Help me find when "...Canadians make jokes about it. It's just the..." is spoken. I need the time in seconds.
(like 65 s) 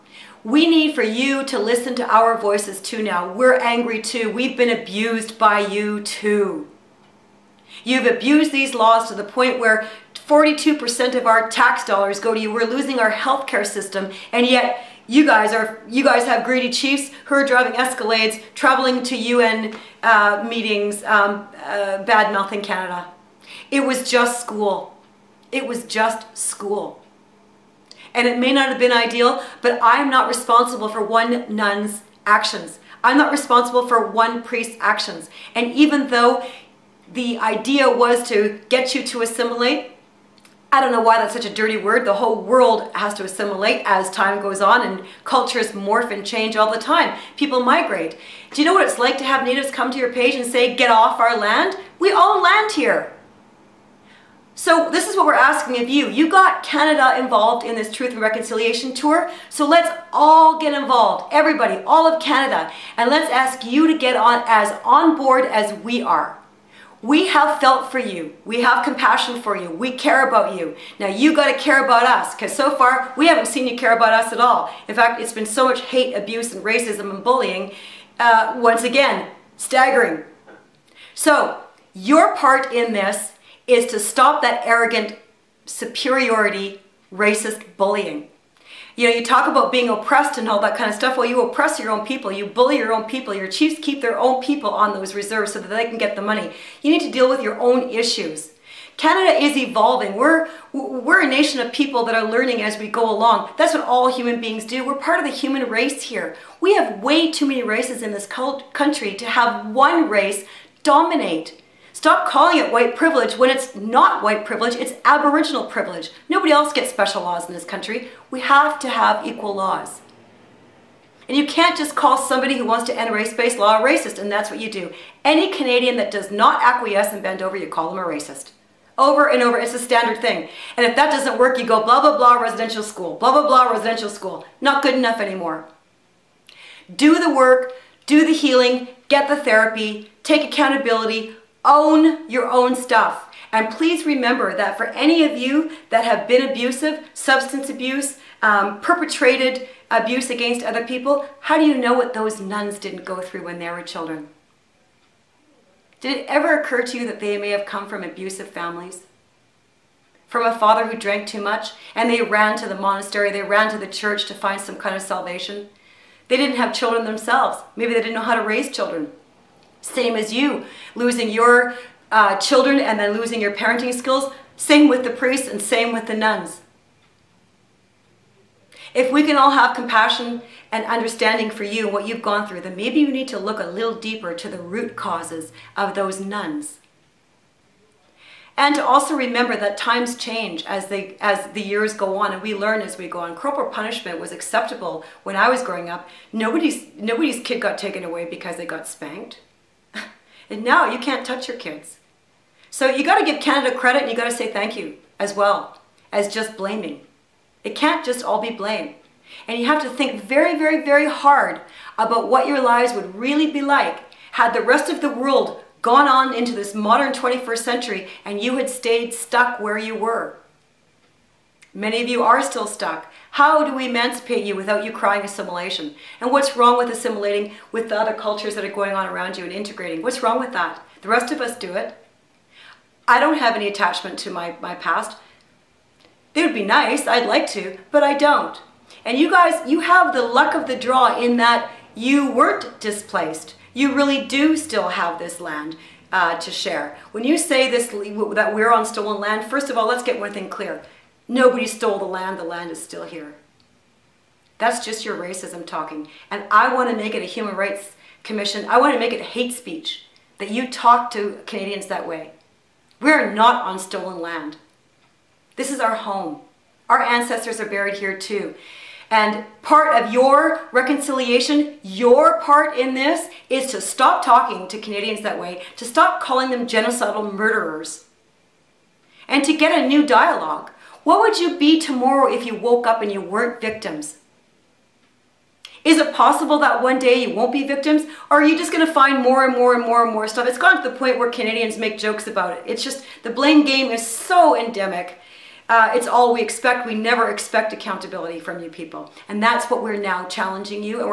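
291 s.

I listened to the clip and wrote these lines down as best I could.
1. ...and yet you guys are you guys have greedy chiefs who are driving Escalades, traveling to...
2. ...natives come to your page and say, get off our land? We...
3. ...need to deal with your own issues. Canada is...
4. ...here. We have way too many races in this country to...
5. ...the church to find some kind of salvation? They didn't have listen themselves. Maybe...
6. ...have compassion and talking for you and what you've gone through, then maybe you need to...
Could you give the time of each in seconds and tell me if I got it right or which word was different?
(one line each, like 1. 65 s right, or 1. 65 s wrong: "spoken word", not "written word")
1. 14 s right
2. 49 s right
3. 96 s right
4. 106 s right
5. 163 s wrong: "children", not "listen"
6. 179 s wrong: "understanding", not "talking".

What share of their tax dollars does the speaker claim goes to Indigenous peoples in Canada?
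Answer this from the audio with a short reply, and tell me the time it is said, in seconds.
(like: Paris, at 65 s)
42%, at 10 s.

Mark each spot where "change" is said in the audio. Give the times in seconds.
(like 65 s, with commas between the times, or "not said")
46 s, 190 s.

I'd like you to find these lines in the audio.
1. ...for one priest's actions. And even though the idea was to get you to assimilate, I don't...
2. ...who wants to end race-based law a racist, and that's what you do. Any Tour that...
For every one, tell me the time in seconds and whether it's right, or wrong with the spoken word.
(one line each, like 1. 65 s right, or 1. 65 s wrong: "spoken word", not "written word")
1. 33 s right
2. 122 s wrong: "Canadian", not "Tour".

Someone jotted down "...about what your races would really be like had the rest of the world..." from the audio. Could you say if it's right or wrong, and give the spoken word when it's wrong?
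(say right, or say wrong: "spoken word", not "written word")
wrong: "lives", not "races".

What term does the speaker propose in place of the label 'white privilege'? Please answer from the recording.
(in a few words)
Aboriginal privilege.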